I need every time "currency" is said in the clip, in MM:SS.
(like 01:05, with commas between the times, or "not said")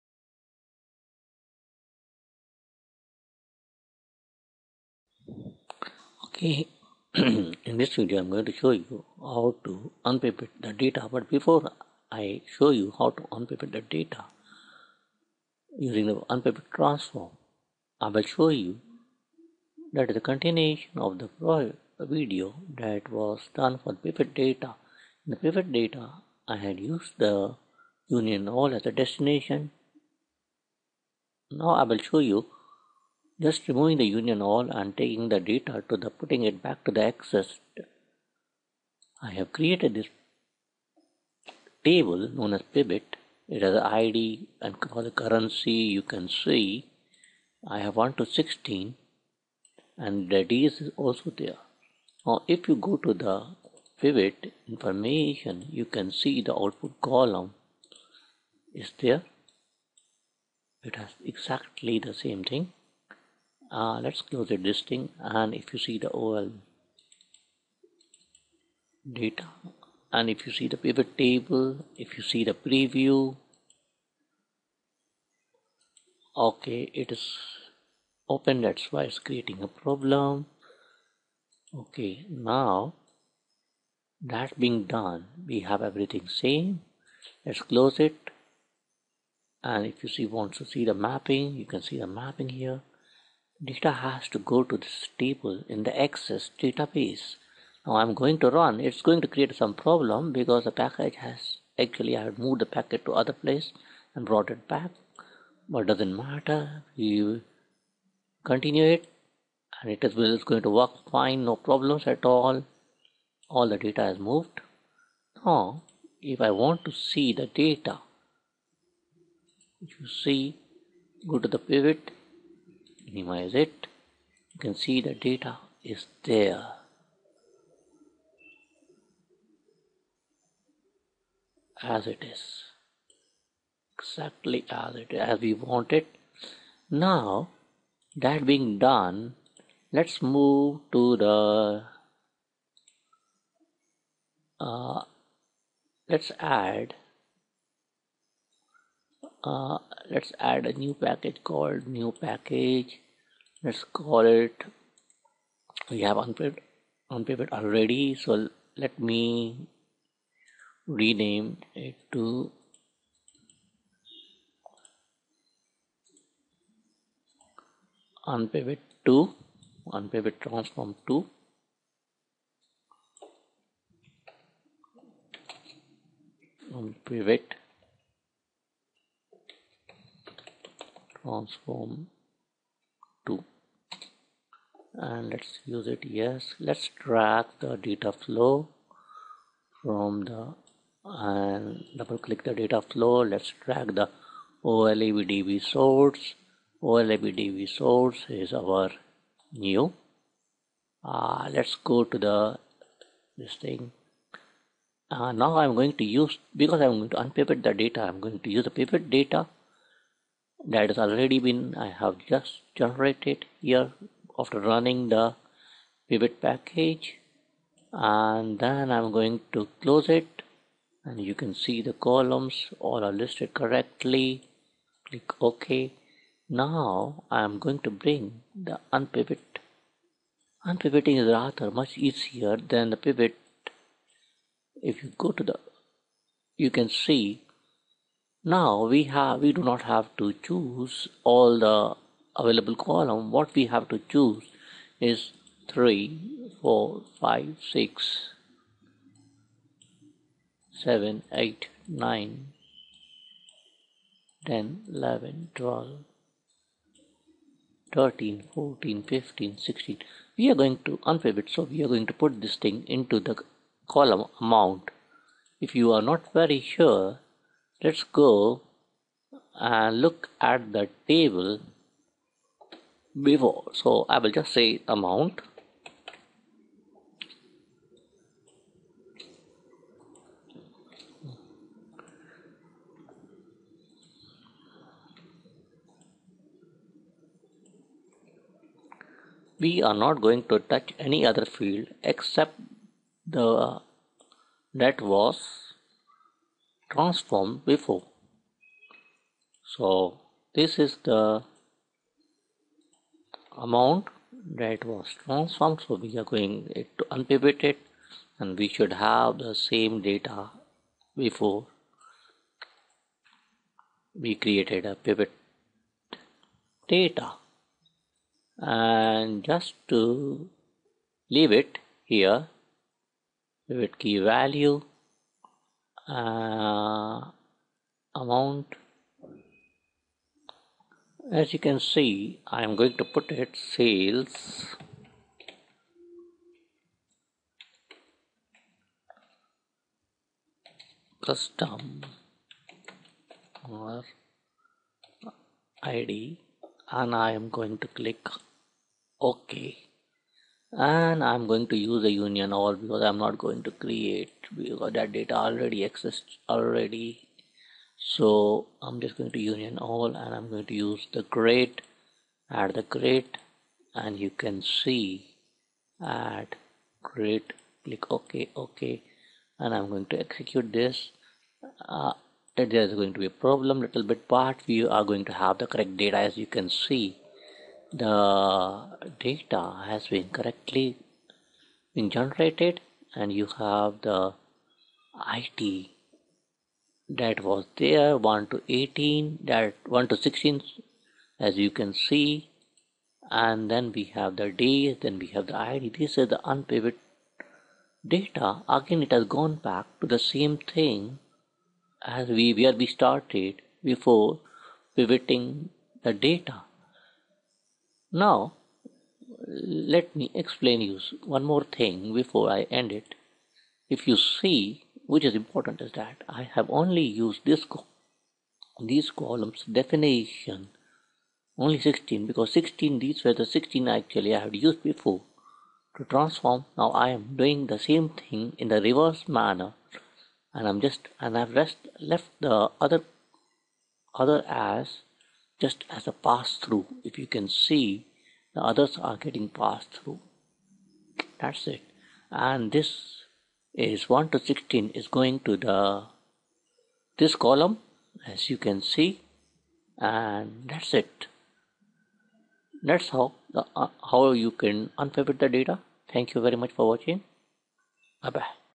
00:45.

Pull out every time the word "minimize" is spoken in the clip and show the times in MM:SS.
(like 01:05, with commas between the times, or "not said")
02:03.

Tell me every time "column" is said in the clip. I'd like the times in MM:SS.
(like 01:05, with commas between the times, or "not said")
00:57, 03:41, 04:02, 04:23, 06:59, 07:27.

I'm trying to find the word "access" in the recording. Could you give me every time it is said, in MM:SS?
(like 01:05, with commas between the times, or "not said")
00:37, 01:36.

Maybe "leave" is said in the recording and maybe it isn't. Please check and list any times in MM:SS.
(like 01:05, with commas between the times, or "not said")
05:21.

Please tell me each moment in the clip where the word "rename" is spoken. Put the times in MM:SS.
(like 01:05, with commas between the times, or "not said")
02:40.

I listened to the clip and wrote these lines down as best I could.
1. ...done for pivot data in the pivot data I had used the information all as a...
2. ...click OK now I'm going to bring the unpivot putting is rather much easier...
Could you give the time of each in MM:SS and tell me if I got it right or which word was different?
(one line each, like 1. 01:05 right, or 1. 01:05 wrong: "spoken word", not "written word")
1. 00:23 wrong: "union", not "information"
2. 03:45 wrong: "unpivoting", not "putting".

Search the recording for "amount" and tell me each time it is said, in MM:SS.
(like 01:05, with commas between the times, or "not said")
04:24, 04:34, 05:03, 05:28.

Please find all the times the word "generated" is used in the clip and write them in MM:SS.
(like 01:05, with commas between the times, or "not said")
03:32, 06:22.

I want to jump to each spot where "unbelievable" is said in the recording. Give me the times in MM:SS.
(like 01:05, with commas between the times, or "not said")
not said.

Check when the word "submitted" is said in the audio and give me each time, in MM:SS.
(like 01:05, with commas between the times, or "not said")
not said.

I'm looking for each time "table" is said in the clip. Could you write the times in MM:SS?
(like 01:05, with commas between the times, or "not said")
00:41, 01:11, 01:35, 04:31.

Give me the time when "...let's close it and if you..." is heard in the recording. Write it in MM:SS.
01:27.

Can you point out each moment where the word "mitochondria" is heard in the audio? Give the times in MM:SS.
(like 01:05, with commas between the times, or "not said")
not said.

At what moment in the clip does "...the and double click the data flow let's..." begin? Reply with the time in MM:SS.
03:10.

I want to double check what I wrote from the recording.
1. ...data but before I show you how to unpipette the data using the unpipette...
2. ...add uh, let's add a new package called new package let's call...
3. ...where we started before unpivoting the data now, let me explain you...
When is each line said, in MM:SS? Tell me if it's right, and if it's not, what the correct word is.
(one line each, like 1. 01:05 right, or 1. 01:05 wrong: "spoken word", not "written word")
1. 00:10 right
2. 02:26 right
3. 06:42 wrong: "pivoting", not "unpivoting".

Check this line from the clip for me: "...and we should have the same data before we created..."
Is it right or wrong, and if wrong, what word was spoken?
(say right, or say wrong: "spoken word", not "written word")
right.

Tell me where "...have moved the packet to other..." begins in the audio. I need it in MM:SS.
01:42.